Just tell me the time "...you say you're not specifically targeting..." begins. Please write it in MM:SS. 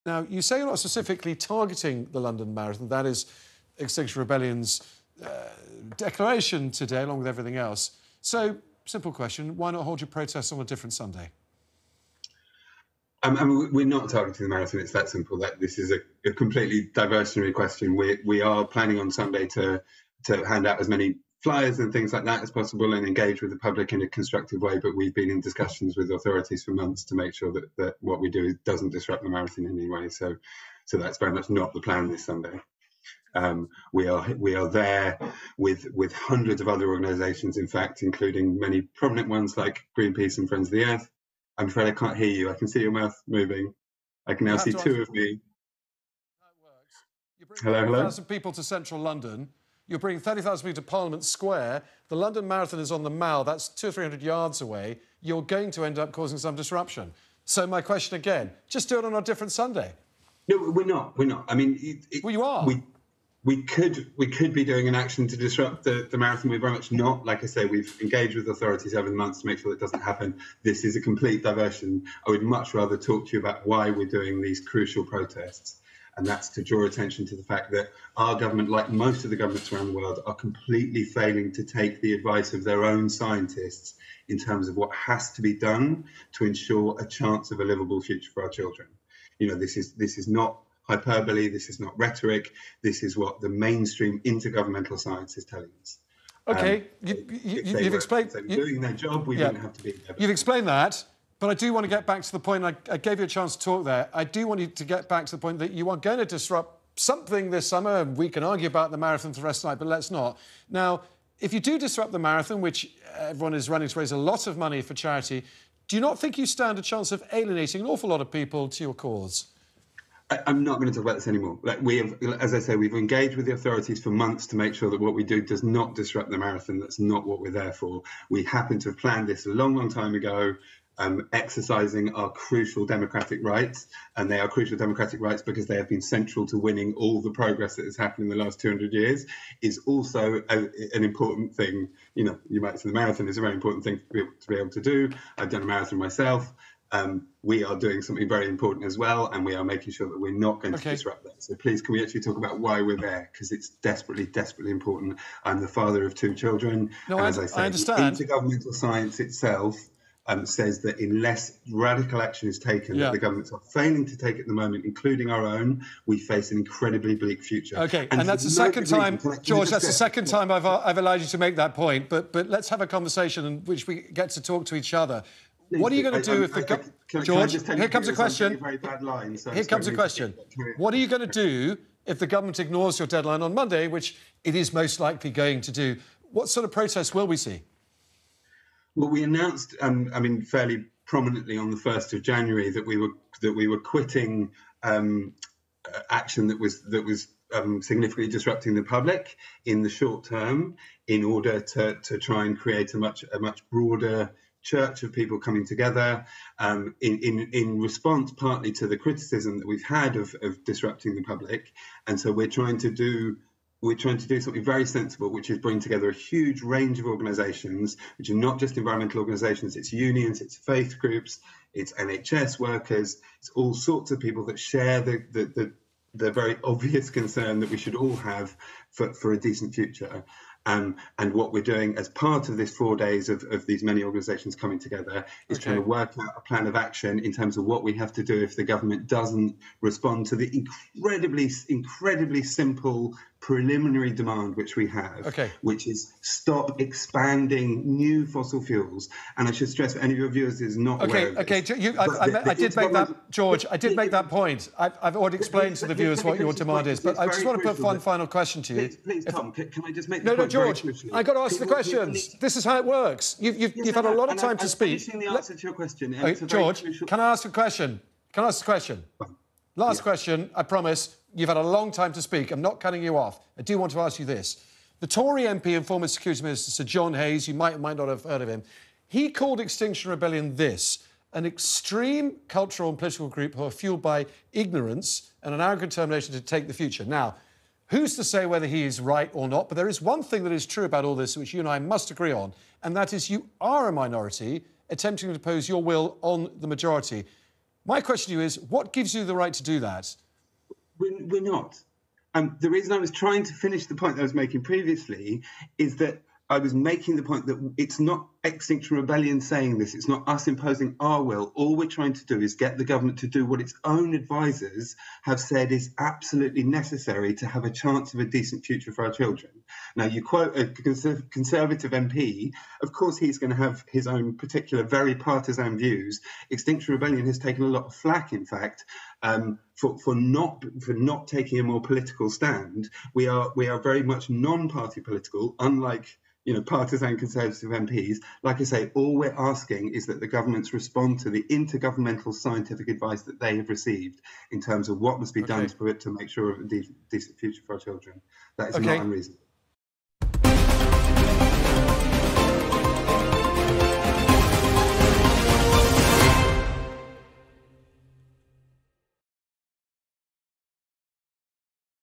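00:00.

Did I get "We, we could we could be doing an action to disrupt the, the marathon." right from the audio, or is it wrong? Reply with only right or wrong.
right.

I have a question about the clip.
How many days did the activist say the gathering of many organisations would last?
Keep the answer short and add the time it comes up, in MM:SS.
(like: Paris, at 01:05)
4, at 03:52.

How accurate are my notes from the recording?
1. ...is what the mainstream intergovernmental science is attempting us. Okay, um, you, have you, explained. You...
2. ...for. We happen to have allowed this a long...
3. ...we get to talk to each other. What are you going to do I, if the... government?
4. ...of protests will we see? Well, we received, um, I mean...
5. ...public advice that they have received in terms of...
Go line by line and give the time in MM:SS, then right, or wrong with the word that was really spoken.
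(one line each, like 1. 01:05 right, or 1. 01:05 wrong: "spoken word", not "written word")
1. 01:33 wrong: "telling", not "attempting"
2. 02:07 wrong: "planned", not "allowed"
3. 02:53 right
4. 03:06 wrong: "announced", not "received"
5. 05:42 wrong: "scientific", not "public".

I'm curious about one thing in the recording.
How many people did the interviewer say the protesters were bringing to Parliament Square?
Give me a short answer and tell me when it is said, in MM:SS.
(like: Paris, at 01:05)
30,000, at 00:50.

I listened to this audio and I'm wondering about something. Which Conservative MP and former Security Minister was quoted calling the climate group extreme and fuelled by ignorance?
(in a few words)
Sir John Hayes.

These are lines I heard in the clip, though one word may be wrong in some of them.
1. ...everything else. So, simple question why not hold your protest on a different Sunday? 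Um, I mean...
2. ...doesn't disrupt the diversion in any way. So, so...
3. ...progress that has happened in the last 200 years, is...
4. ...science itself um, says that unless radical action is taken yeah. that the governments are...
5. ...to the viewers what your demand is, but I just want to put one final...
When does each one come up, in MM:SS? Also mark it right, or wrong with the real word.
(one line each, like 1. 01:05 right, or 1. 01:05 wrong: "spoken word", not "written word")
1. 00:07 right
2. 00:28 wrong: "marathon", not "diversion"
3. 02:17 right
4. 02:38 right
5. 04:15 right.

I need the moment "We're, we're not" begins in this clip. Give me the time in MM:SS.
05:00.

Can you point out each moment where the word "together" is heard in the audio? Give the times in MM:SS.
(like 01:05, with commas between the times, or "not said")
03:25, 03:35, 03:54.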